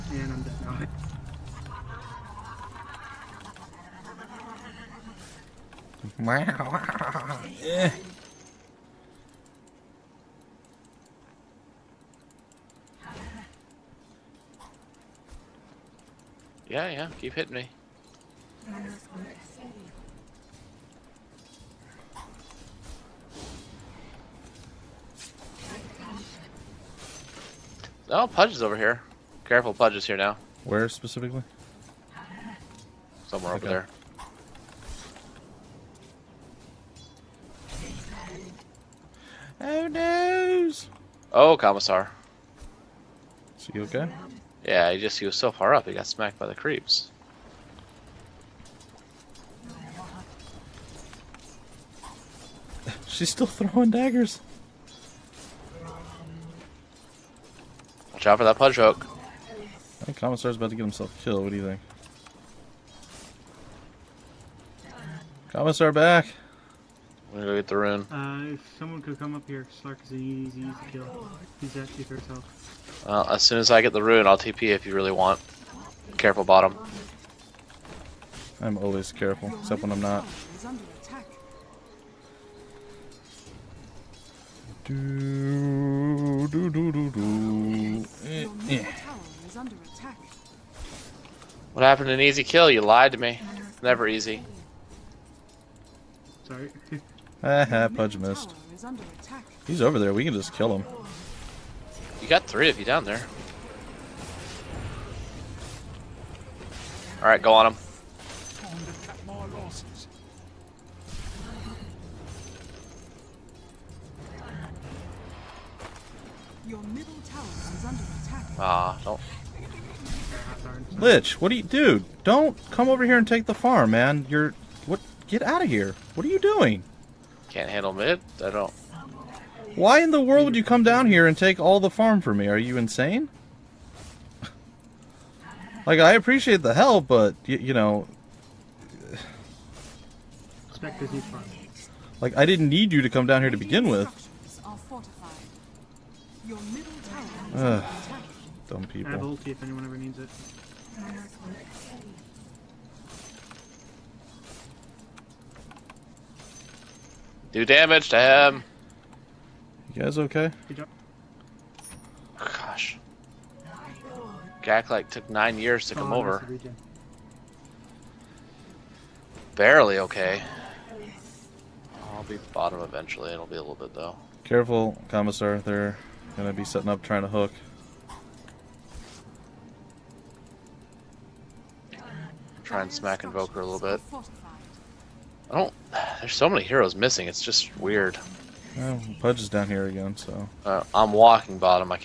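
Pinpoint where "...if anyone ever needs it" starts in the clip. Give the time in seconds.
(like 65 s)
149 s.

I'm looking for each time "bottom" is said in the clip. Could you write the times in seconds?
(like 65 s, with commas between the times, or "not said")
76 s, 172 s.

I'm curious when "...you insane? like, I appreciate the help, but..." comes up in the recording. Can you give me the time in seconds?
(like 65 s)
132 s.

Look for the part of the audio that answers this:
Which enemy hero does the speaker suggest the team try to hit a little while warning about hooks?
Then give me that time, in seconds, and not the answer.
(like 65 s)
183 s.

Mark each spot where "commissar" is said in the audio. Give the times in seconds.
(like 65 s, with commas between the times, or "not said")
41 s, 60 s, 65 s, 175 s.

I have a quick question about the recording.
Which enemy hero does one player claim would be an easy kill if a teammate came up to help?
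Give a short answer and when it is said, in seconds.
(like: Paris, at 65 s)
Slark, at 69 s.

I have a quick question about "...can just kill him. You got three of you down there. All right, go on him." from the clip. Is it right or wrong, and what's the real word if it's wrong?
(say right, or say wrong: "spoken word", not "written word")
right.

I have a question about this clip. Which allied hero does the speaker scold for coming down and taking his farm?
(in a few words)
Lich.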